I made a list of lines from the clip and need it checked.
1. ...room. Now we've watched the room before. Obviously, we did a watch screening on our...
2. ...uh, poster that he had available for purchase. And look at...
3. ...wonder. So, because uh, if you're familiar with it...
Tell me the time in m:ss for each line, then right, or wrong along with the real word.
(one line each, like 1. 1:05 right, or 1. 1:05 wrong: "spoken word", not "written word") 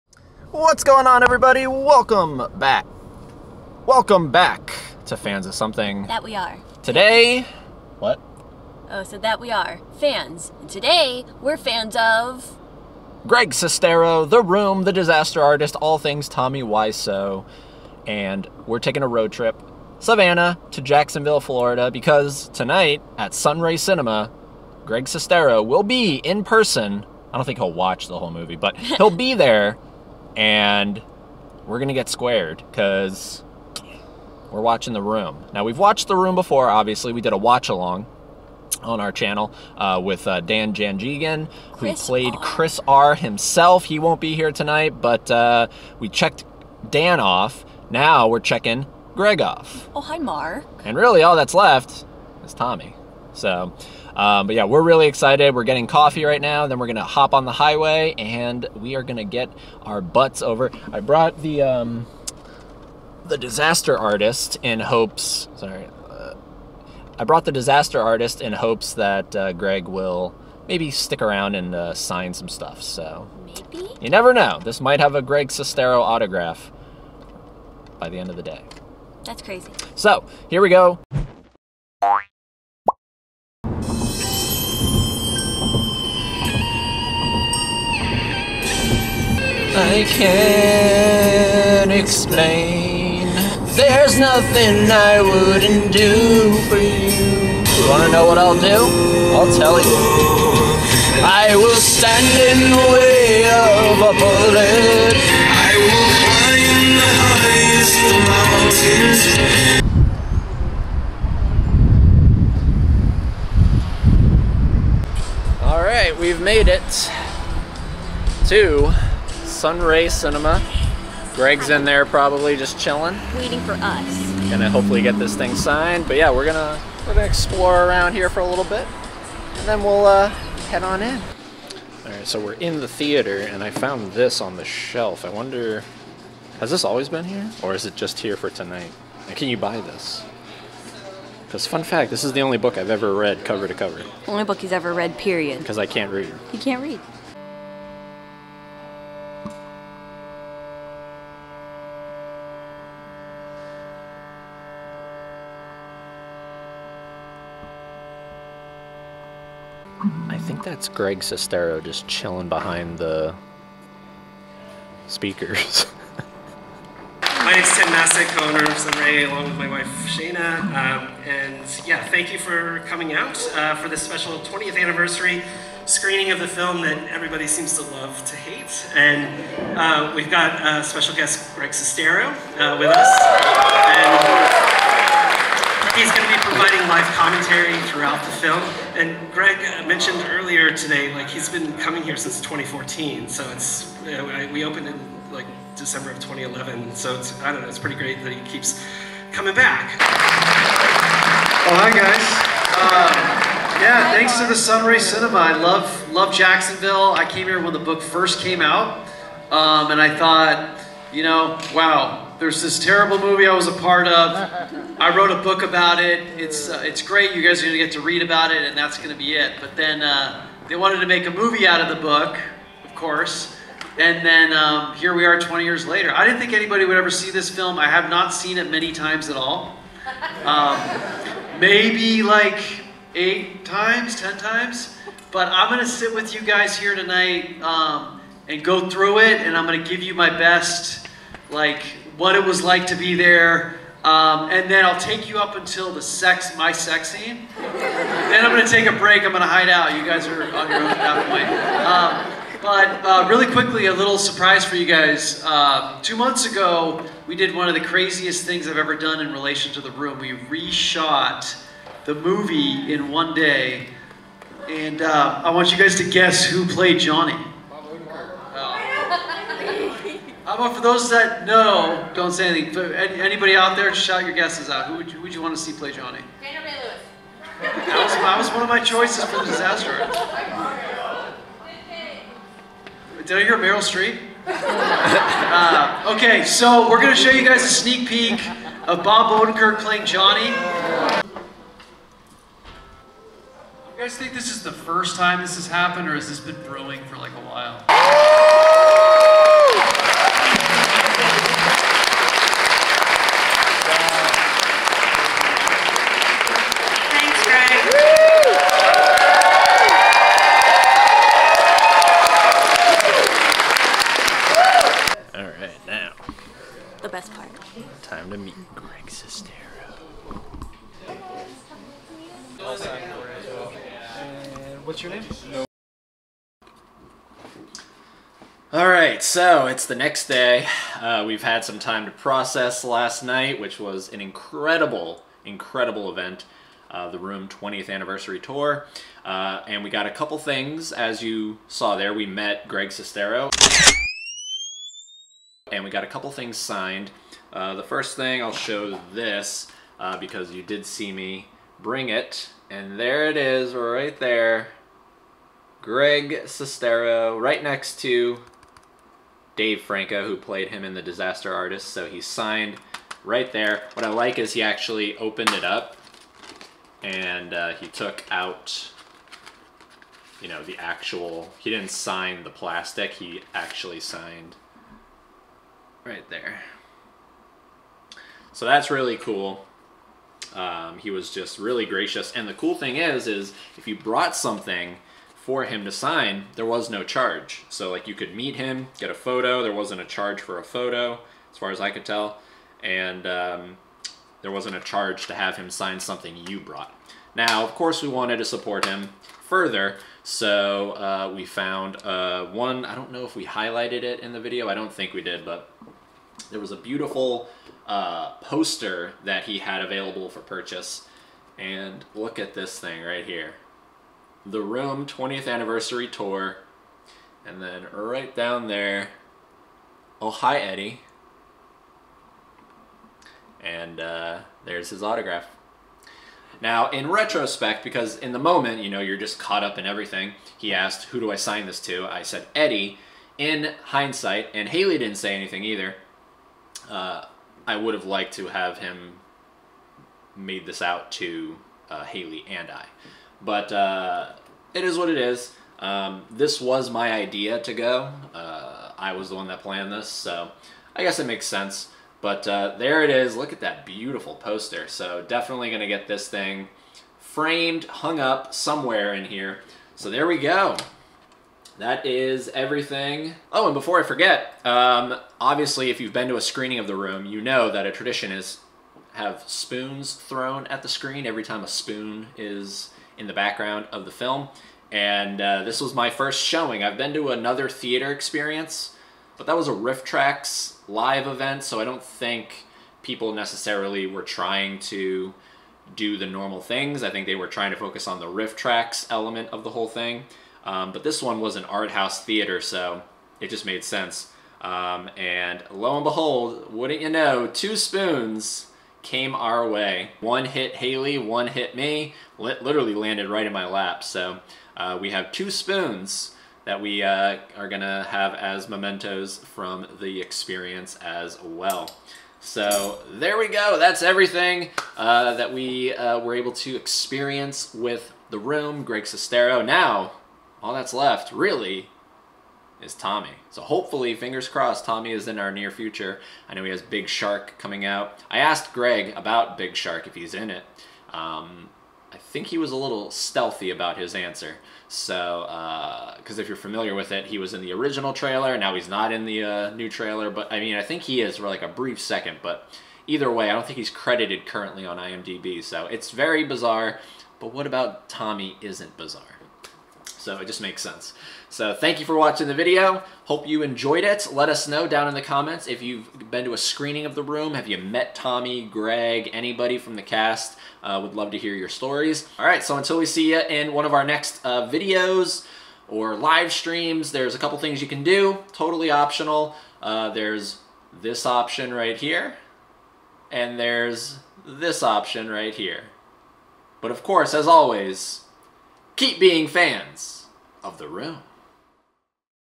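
1. 0:35 wrong: "along", not "screening"
2. 6:47 right
3. 8:54 wrong: "answer", not "wonder".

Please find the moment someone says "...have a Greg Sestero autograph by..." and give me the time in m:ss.
1:14.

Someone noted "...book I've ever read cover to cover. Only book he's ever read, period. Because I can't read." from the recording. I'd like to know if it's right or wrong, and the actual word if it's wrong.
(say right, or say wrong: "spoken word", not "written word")
right.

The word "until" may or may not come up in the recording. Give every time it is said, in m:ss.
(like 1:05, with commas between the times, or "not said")
4:05, 9:22.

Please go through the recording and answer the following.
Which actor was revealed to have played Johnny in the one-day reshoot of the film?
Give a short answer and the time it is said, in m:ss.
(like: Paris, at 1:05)
Bob Odenkirk, at 4:49.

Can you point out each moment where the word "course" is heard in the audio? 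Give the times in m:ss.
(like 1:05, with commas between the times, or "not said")
3:42, 6:37, 9:37.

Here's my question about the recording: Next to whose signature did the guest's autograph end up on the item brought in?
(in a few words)
Dave Franco.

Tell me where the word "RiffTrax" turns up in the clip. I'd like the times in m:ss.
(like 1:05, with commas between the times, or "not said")
7:59, 8:08.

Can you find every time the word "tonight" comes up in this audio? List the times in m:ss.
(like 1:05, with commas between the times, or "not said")
0:22, 0:44, 2:18, 3:56.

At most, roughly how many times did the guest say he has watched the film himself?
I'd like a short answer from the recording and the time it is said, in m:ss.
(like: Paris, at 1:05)
10 times, at 3:54.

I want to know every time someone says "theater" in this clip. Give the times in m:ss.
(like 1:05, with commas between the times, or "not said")
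2:12, 7:57, 8:12.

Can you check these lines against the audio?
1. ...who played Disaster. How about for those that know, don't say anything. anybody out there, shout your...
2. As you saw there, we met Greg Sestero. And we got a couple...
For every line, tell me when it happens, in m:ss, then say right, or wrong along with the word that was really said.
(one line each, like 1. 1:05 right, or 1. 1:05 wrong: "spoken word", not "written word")
1. 4:26 wrong: "Johnny", not "Disaster"
2. 5:40 right.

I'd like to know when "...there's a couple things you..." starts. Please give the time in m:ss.
9:27.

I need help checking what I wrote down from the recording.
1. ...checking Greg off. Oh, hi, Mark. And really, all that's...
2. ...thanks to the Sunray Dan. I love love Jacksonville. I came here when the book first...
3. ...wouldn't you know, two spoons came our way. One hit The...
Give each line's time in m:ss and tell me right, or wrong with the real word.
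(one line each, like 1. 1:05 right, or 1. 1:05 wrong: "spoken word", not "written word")
1. 0:48 right
2. 3:24 wrong: "Cinema", not "Dan"
3. 8:16 wrong: "Haley", not "The".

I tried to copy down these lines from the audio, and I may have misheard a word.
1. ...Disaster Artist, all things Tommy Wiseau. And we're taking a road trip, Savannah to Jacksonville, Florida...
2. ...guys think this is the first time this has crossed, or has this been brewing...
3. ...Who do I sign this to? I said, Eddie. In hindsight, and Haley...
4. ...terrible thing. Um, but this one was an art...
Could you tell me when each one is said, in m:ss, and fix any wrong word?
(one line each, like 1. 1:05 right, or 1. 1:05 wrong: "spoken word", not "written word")
1. 0:14 right
2. 4:54 wrong: "happened", not "crossed"
3. 7:11 right
4. 8:09 wrong: "whole", not "terrible".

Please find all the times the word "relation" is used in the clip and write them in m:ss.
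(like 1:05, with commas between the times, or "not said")
4:19.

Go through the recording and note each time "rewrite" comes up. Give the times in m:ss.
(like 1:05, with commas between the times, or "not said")
not said.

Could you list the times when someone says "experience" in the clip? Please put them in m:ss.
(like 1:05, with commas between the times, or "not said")
7:58, 8:30, 8:36.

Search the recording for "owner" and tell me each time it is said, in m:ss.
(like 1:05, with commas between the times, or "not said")
2:48.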